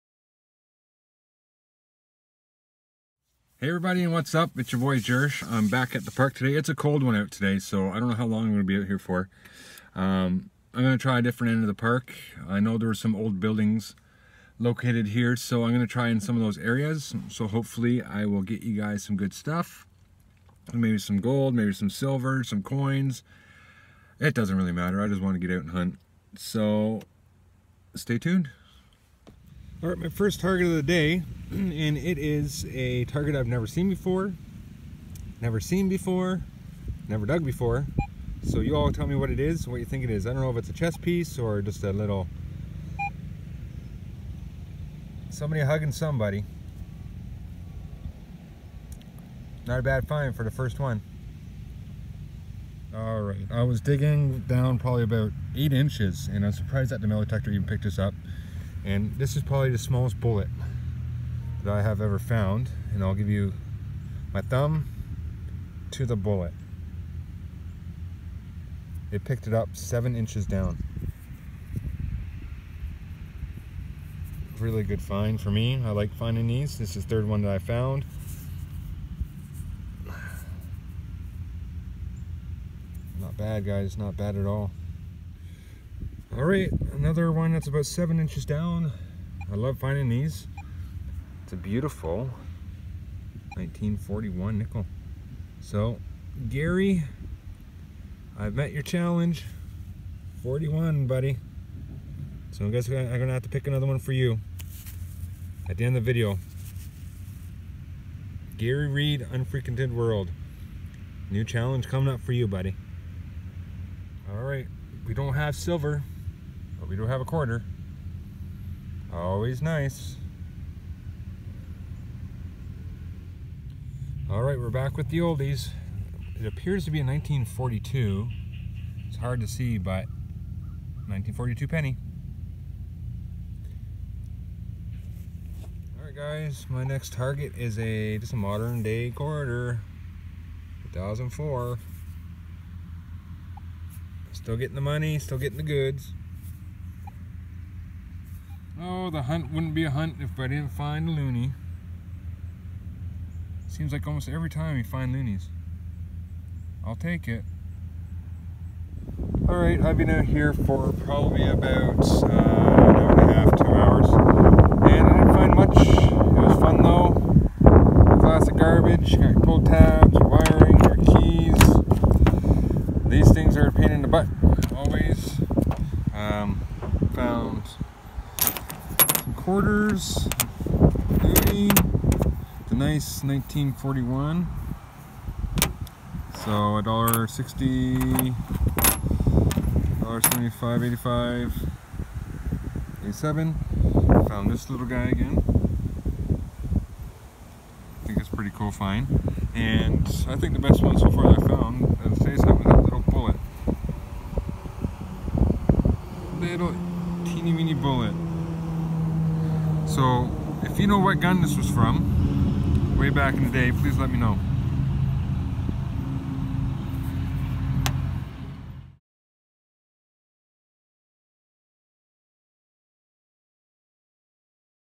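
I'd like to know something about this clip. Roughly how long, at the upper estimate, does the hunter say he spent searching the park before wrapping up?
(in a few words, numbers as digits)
2 hours.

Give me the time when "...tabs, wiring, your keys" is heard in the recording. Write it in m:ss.
2:49.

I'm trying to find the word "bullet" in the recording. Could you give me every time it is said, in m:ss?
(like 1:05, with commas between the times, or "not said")
1:00, 1:06, 3:23, 3:27.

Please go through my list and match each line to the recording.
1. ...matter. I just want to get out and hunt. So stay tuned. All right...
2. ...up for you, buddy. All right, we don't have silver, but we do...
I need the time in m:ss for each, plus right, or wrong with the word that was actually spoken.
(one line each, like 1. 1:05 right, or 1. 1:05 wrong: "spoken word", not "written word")
1. 0:24 right
2. 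1:52 right.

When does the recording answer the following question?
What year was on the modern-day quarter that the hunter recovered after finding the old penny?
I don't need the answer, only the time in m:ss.
2:20.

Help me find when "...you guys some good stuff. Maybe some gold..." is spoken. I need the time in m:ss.
0:18.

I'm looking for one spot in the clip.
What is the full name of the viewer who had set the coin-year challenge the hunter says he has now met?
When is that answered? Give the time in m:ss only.
1:48.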